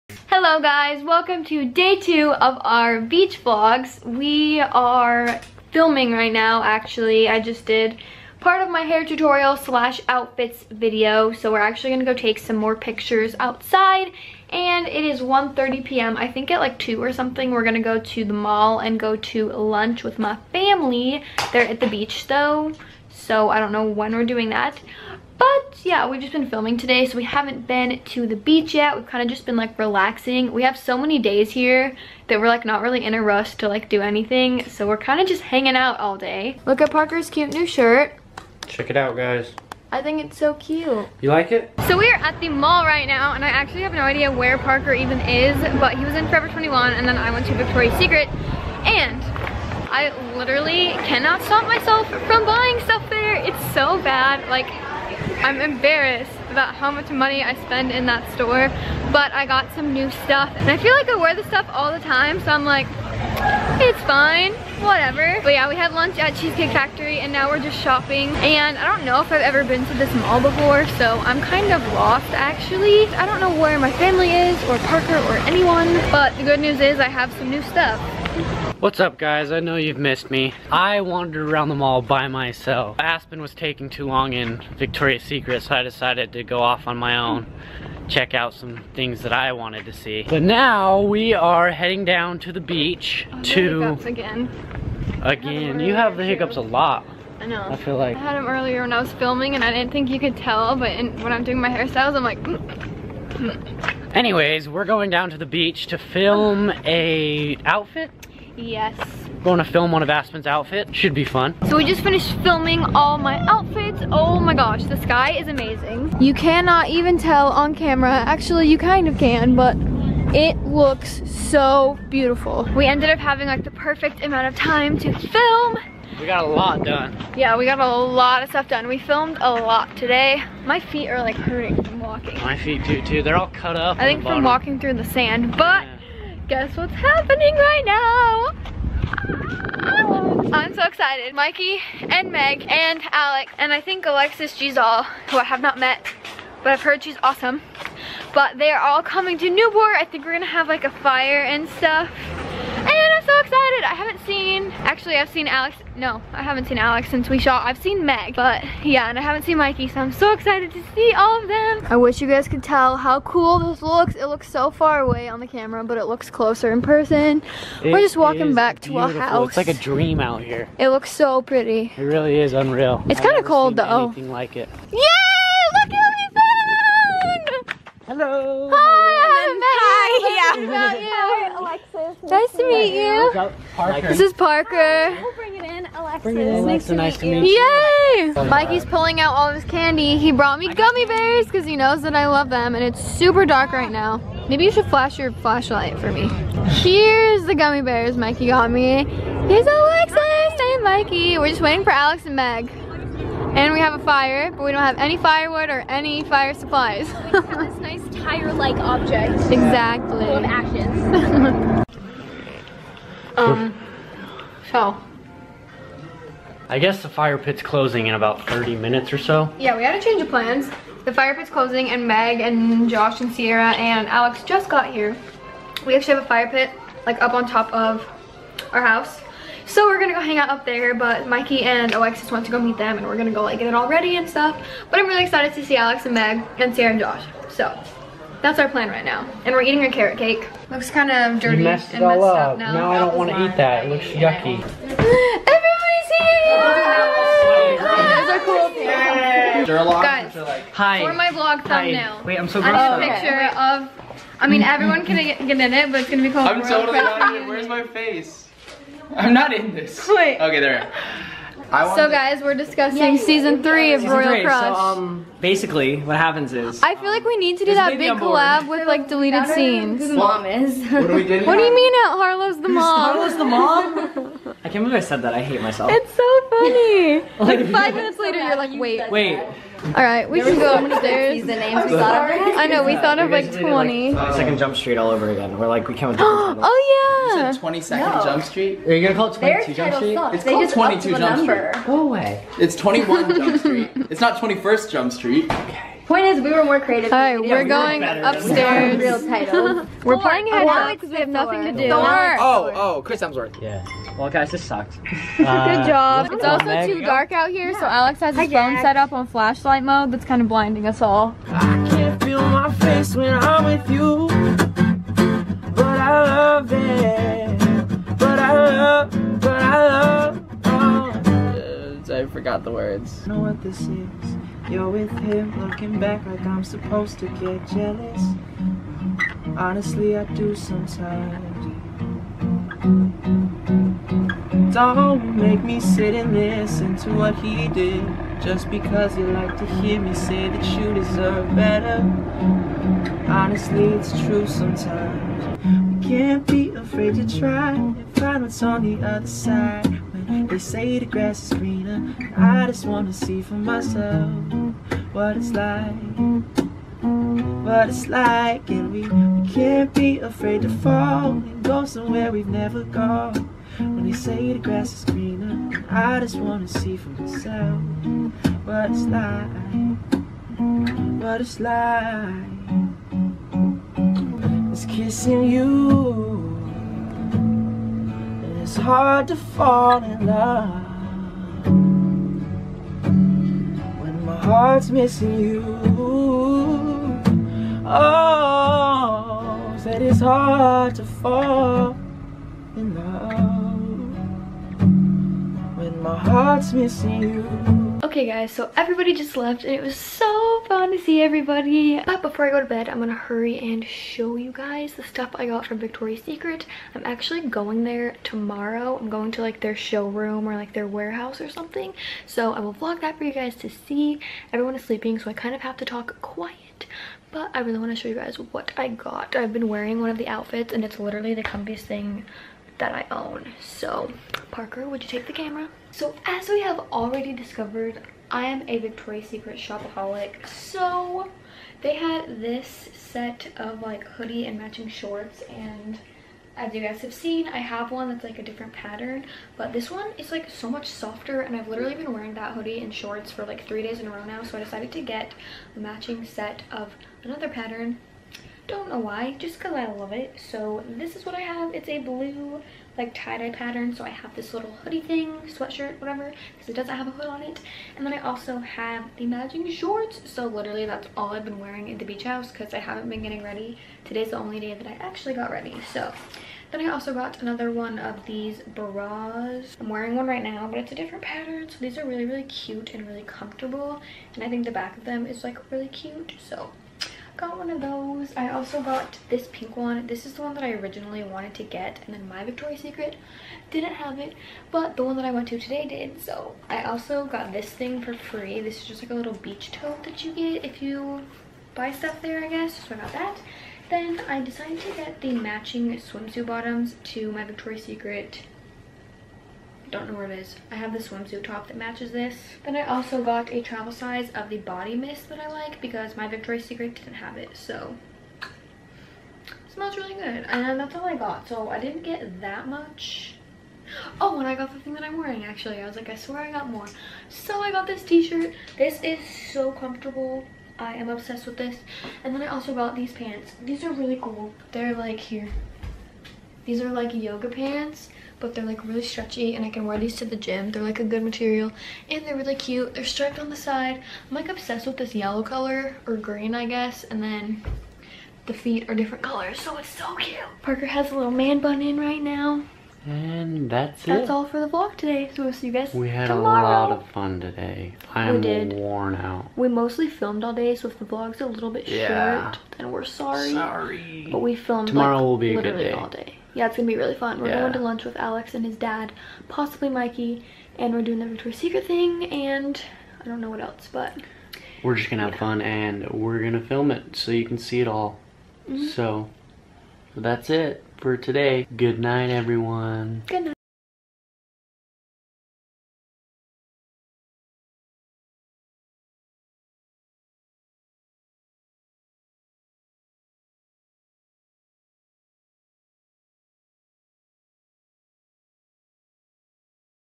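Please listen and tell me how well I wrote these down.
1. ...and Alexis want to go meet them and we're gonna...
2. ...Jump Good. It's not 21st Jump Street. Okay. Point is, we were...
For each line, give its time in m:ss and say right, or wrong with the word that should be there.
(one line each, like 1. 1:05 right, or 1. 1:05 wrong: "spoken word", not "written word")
1. 3:51 right
2. 4:53 wrong: "Street", not "Good".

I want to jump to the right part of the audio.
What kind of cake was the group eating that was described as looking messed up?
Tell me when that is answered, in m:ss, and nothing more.
3:59.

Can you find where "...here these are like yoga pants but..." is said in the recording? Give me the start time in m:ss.
8:45.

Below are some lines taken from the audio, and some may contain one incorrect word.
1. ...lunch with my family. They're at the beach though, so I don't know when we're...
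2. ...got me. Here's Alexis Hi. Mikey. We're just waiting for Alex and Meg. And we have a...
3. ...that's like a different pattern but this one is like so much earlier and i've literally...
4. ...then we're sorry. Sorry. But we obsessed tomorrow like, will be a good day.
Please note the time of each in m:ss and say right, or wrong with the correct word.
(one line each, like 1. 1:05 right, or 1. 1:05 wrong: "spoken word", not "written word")
1. 0:19 right
2. 3:18 right
3. 7:18 wrong: "softer", not "earlier"
4. 9:12 wrong: "filmed", not "obsessed".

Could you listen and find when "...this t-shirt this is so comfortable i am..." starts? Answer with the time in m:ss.
8:37.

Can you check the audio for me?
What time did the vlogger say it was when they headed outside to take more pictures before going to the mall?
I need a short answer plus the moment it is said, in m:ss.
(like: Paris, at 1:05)
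1:30 p.m., at 0:15.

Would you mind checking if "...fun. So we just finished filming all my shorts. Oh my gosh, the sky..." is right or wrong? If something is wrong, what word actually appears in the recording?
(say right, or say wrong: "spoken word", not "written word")
wrong: "outfits", not "shorts".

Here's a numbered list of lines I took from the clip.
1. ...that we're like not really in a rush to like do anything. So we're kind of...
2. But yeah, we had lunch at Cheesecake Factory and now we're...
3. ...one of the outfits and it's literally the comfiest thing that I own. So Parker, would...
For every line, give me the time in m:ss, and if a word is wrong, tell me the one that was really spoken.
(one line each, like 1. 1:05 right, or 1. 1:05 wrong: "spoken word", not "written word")
1. 0:32 right
2. 1:05 right
3. 7:00 right.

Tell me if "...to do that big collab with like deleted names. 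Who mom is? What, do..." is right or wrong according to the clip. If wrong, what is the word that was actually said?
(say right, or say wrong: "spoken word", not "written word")
wrong: "scenes", not "names".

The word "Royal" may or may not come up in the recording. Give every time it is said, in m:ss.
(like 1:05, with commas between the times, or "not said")
4:16, 4:24.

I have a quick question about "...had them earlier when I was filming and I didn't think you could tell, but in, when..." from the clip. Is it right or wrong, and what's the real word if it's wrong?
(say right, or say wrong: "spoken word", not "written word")
right.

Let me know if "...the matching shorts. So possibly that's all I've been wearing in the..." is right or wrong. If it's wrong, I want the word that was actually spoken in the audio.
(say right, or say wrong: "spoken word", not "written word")
wrong: "literally", not "possibly".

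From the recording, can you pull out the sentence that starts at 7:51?
So these are really, really cute and really comfortable.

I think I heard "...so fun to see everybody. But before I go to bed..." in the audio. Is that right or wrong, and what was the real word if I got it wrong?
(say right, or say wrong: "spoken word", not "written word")
right.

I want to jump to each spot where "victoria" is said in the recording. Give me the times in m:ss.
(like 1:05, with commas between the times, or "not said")
0:47, 1:24, 6:45, 7:08, 8:02, 8:17, 8:26, 9:21.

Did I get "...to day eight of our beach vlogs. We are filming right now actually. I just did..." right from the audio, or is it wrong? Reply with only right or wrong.
wrong.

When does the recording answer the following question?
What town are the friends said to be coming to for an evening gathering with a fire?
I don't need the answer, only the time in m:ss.
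2:29.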